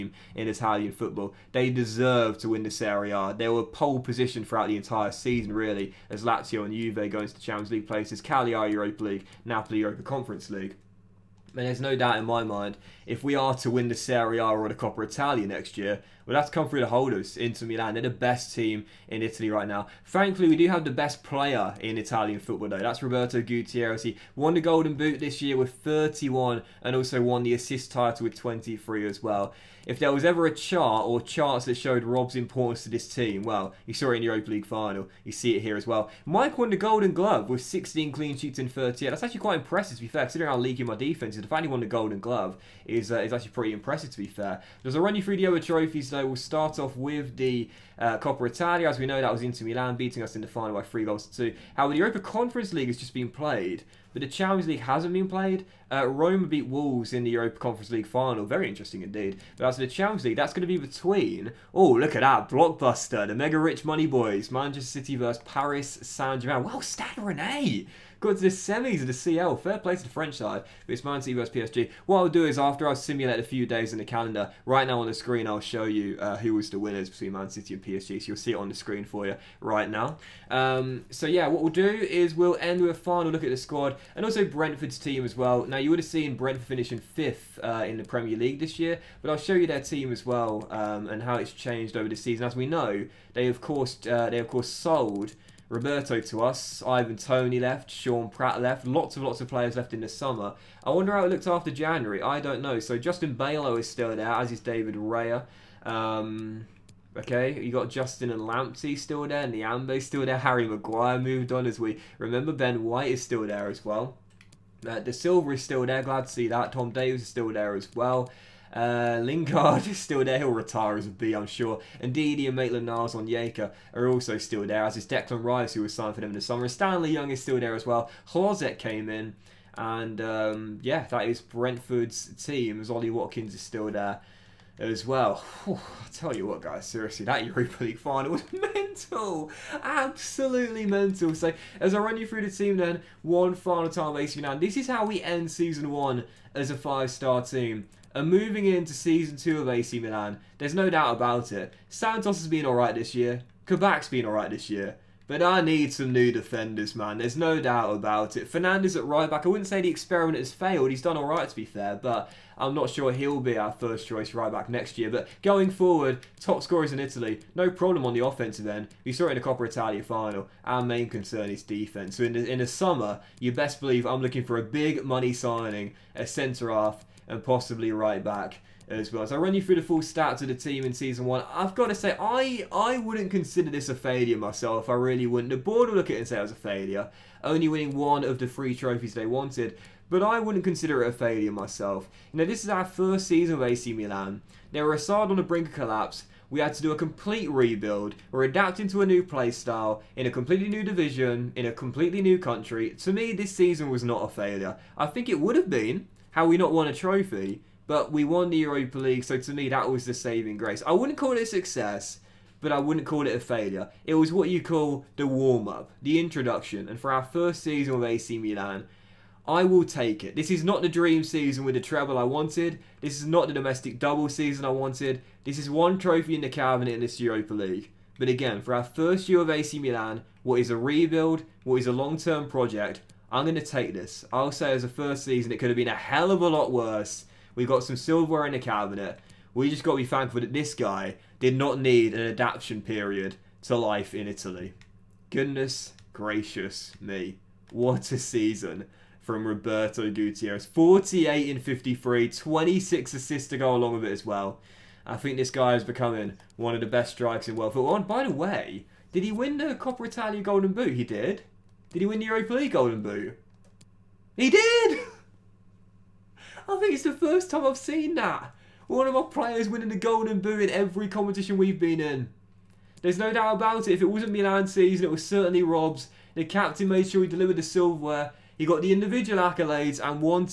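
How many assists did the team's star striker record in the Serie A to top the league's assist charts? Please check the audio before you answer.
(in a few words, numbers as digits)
23.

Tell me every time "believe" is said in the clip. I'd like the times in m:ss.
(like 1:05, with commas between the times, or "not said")
2:53.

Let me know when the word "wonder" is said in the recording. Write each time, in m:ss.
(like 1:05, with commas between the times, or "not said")
1:40.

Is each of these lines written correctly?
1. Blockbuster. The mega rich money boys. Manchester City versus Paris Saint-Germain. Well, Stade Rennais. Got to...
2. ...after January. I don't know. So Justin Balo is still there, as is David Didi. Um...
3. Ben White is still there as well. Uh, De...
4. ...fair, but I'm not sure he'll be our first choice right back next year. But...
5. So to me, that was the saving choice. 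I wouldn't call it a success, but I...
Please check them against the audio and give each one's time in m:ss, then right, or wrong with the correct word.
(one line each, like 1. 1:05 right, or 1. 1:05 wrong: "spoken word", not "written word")
1. 1:02 right
2. 1:41 wrong: "Raya", not "Didi"
3. 1:52 right
4. 2:41 right
5. 3:29 wrong: "grace", not "choice".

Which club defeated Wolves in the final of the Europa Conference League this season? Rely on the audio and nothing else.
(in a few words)
Roma.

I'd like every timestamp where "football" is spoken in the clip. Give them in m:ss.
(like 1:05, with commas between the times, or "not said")
0:00, 0:22, 4:17.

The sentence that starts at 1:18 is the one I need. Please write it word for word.
So you'll see it on the screen for you right now.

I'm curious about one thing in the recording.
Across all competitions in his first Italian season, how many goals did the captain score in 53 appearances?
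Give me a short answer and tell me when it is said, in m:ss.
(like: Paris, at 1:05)
48, at 4:10.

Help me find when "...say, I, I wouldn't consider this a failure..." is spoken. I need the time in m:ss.
3:01.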